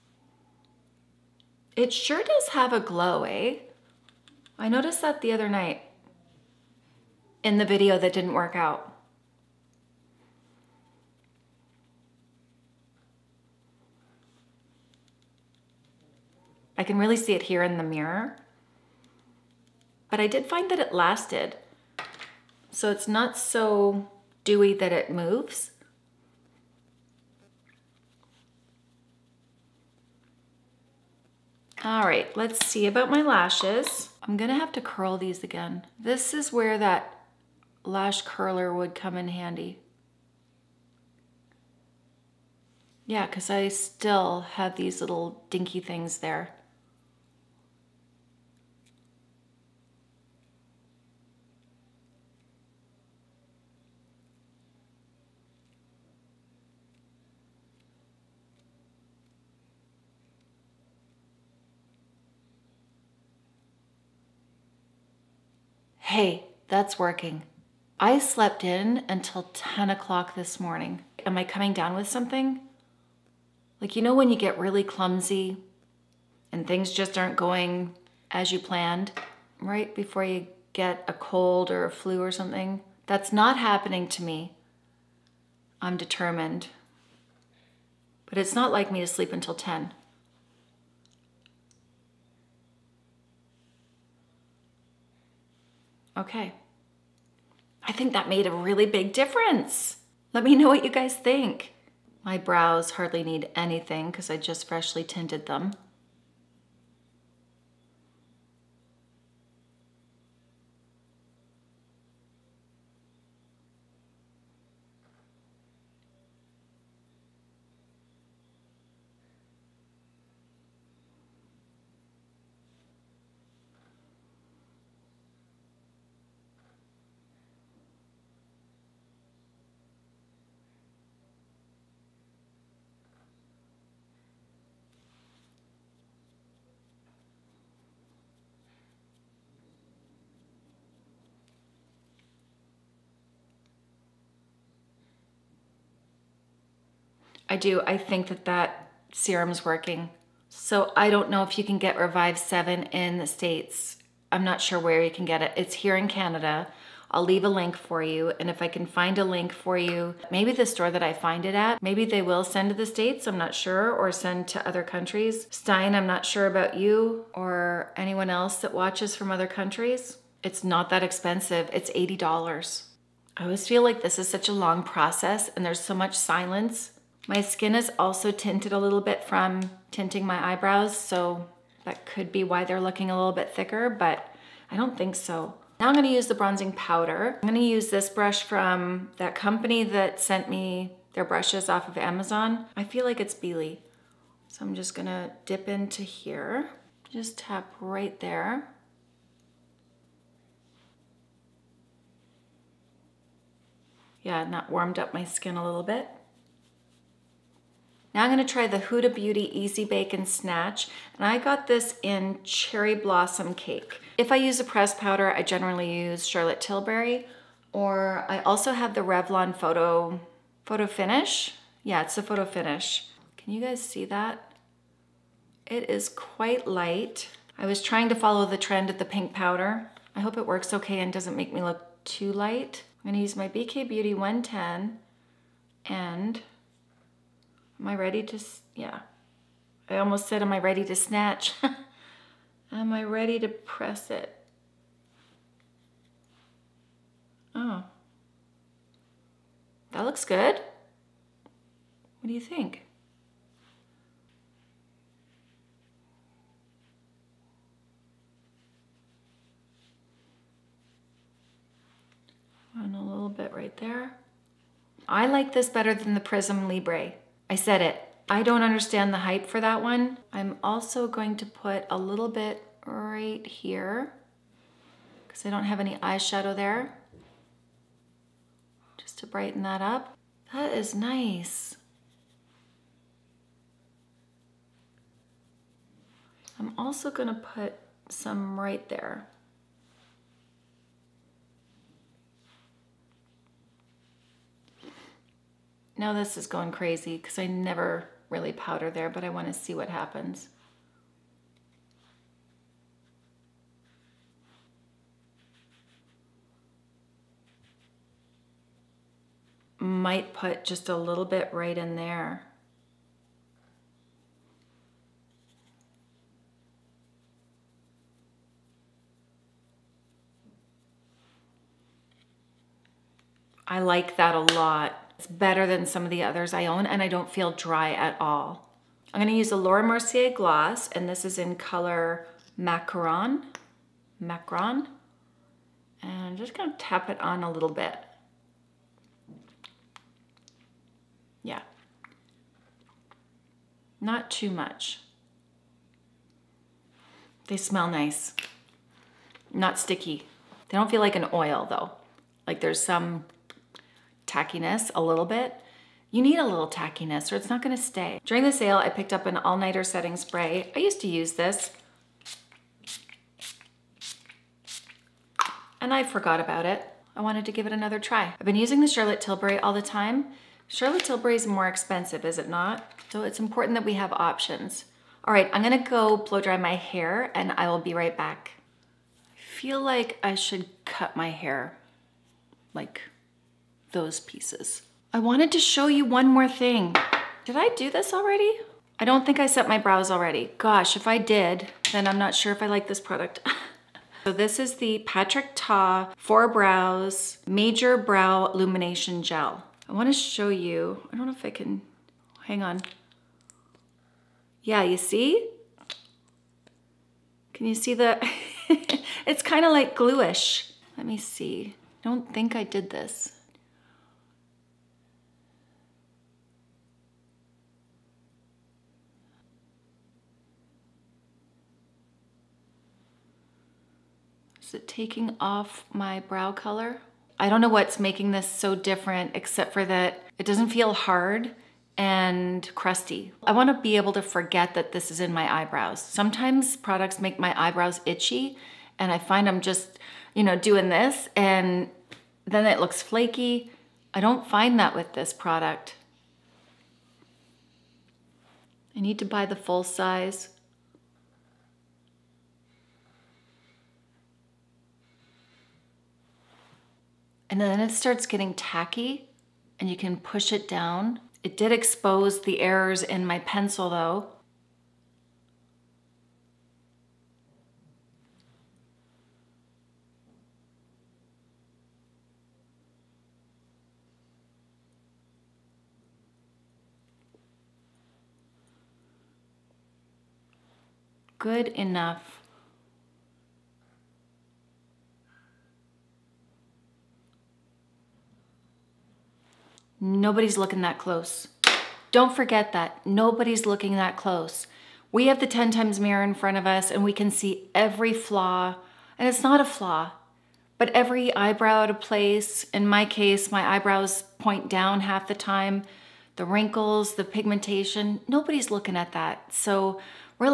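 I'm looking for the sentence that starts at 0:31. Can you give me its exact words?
All right, let's see about my lashes.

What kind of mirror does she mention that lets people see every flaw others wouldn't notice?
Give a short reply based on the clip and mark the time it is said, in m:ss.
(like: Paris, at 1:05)
10 times mirror, at 8:15.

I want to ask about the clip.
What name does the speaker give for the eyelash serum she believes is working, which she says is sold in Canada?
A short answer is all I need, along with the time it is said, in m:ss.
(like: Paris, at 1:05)
Revive 7, at 2:31.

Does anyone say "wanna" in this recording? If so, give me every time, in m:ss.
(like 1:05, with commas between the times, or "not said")
6:39, 7:13.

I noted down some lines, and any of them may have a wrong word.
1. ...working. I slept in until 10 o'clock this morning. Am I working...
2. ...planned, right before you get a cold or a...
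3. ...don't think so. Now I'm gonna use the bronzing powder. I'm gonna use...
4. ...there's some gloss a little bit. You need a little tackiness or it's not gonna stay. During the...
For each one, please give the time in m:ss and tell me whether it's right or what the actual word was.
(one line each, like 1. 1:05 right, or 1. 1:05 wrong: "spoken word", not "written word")
1. 1:06 wrong: "coming", not "working"
2. 1:18 right
3. 3:04 right
4. 5:52 wrong: "tackiness", not "gloss".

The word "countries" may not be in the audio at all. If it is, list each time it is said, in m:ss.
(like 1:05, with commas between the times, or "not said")
2:44, 2:49.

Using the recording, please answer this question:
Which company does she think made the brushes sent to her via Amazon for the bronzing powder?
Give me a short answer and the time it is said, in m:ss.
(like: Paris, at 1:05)
BEILI, at 3:13.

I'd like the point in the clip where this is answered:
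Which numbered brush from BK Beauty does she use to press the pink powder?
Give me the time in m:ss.
3:54.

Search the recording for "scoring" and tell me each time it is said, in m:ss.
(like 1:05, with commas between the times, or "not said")
not said.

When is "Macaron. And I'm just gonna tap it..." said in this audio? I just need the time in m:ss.
5:34.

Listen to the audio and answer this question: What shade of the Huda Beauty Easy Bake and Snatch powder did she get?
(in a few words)
Cherry Blossom Cake.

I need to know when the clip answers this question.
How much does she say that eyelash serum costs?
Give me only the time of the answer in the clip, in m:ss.
2:51.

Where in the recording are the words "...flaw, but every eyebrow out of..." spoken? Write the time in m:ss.
8:19.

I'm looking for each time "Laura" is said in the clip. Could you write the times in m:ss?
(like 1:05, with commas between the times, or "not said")
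5:29.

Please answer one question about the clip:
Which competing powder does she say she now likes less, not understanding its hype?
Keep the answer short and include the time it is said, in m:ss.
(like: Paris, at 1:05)
Prisme Libre, at 4:26.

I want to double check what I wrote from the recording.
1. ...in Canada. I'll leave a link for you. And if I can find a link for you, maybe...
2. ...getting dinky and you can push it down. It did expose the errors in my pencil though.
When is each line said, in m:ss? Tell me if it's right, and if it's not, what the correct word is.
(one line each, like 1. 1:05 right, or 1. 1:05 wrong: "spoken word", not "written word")
1. 2:35 right
2. 7:38 wrong: "tacky", not "dinky".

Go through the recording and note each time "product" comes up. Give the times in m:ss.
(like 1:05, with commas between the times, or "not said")
6:33, 7:16, 7:25.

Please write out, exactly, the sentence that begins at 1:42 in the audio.
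My brows hardly need anything because I just freshly tinted them.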